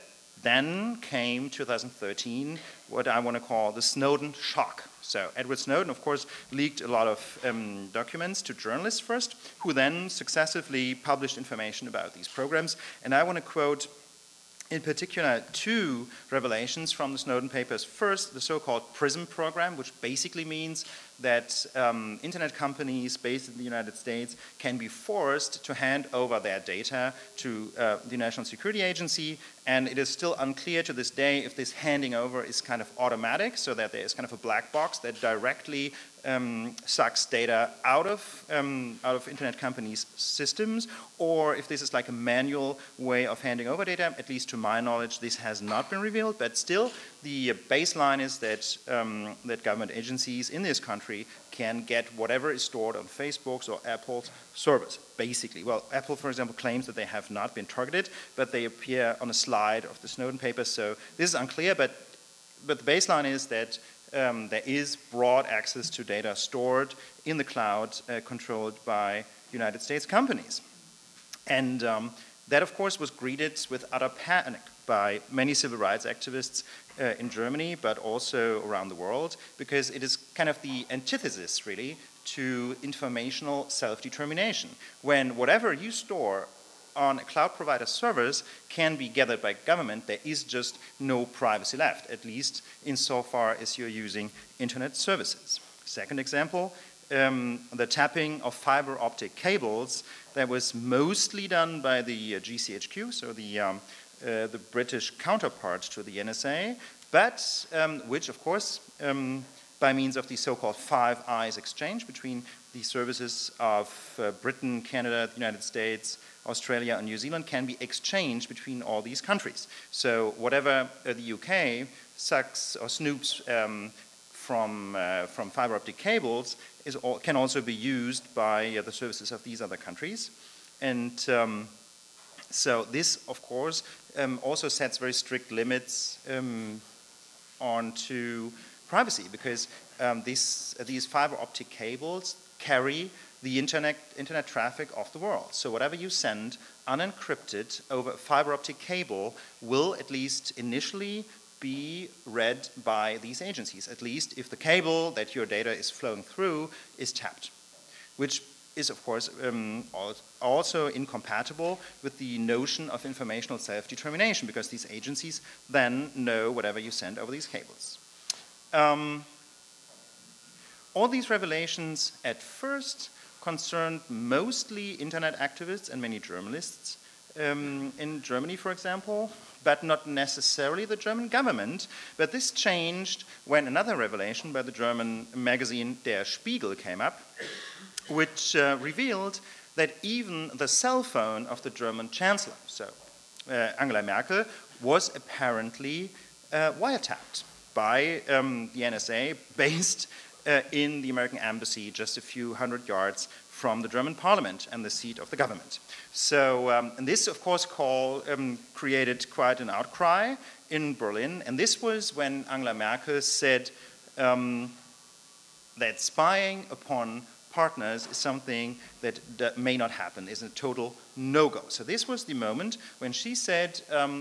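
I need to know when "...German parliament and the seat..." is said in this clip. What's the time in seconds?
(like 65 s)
203 s.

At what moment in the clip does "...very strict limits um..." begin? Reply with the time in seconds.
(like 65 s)
134 s.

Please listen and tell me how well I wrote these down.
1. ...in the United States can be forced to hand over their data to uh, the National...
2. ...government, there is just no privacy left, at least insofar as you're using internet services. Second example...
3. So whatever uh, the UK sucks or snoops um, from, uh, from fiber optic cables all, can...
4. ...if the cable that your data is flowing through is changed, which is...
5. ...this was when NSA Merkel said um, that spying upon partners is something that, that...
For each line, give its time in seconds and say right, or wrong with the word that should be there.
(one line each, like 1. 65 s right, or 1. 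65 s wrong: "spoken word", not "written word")
1. 23 s right
2. 89 s right
3. 119 s right
4. 154 s wrong: "tapped", not "changed"
5. 211 s wrong: "Angela", not "NSA".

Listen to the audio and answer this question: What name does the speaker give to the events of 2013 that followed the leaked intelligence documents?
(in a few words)
Snowden shock.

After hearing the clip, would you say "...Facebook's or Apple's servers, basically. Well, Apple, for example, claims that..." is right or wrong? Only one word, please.
right.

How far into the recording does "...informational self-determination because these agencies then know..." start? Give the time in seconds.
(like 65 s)
163 s.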